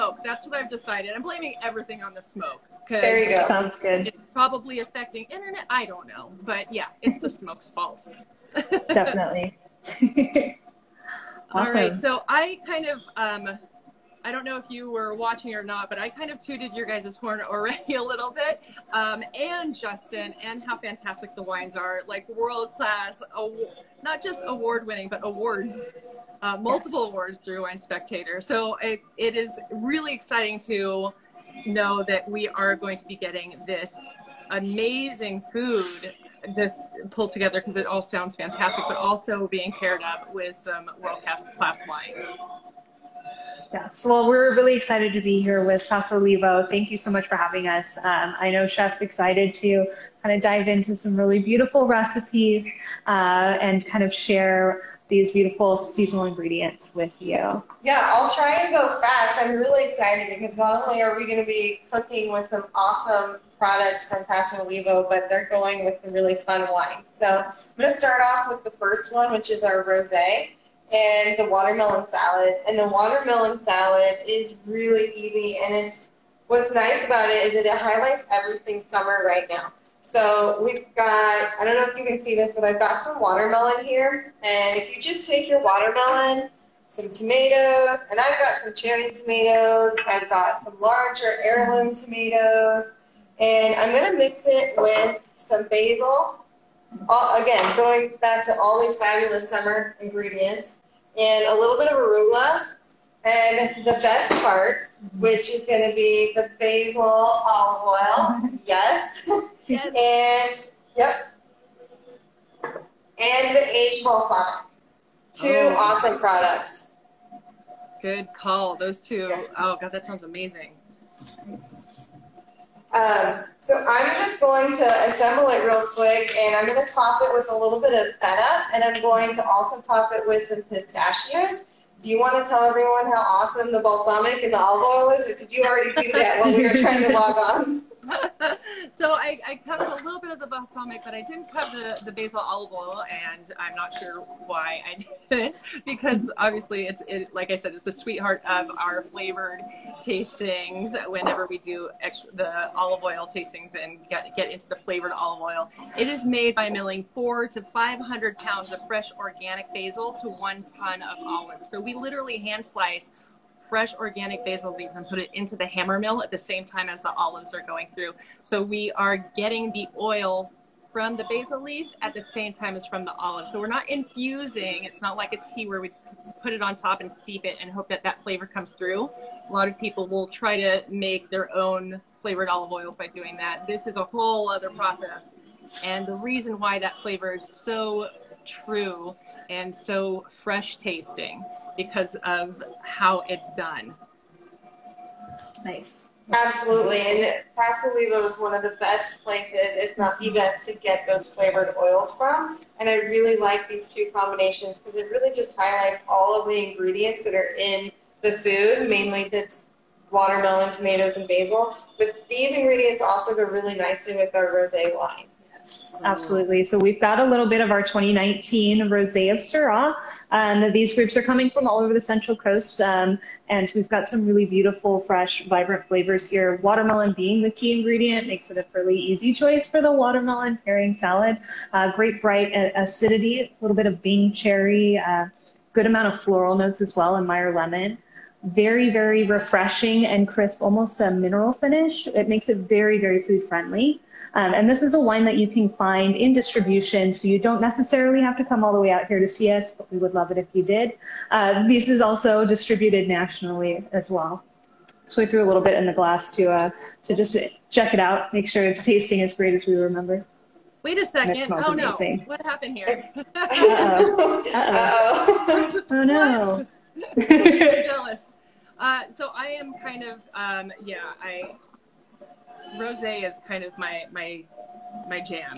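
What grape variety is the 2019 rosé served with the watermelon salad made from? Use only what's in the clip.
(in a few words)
Syrah.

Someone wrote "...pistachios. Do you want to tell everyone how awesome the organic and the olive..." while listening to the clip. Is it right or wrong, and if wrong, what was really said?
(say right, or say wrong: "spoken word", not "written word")
wrong: "balsamic", not "organic".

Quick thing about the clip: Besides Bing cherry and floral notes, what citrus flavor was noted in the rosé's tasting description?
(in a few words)
Meyer lemon.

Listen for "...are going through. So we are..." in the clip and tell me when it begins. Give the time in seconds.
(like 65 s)
167 s.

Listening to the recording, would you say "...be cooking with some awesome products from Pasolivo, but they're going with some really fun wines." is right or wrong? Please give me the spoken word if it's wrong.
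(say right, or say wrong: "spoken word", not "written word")
right.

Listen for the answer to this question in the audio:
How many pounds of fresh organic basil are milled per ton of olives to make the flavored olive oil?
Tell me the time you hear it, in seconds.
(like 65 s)
157 s.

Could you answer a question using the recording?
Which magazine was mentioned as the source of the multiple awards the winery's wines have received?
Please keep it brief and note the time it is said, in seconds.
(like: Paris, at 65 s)
Wine Spectator, at 27 s.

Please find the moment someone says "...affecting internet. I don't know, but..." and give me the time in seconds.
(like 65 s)
4 s.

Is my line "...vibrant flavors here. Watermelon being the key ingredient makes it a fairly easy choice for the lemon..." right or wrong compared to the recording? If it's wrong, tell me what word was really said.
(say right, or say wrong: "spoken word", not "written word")
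wrong: "watermelon", not "lemon".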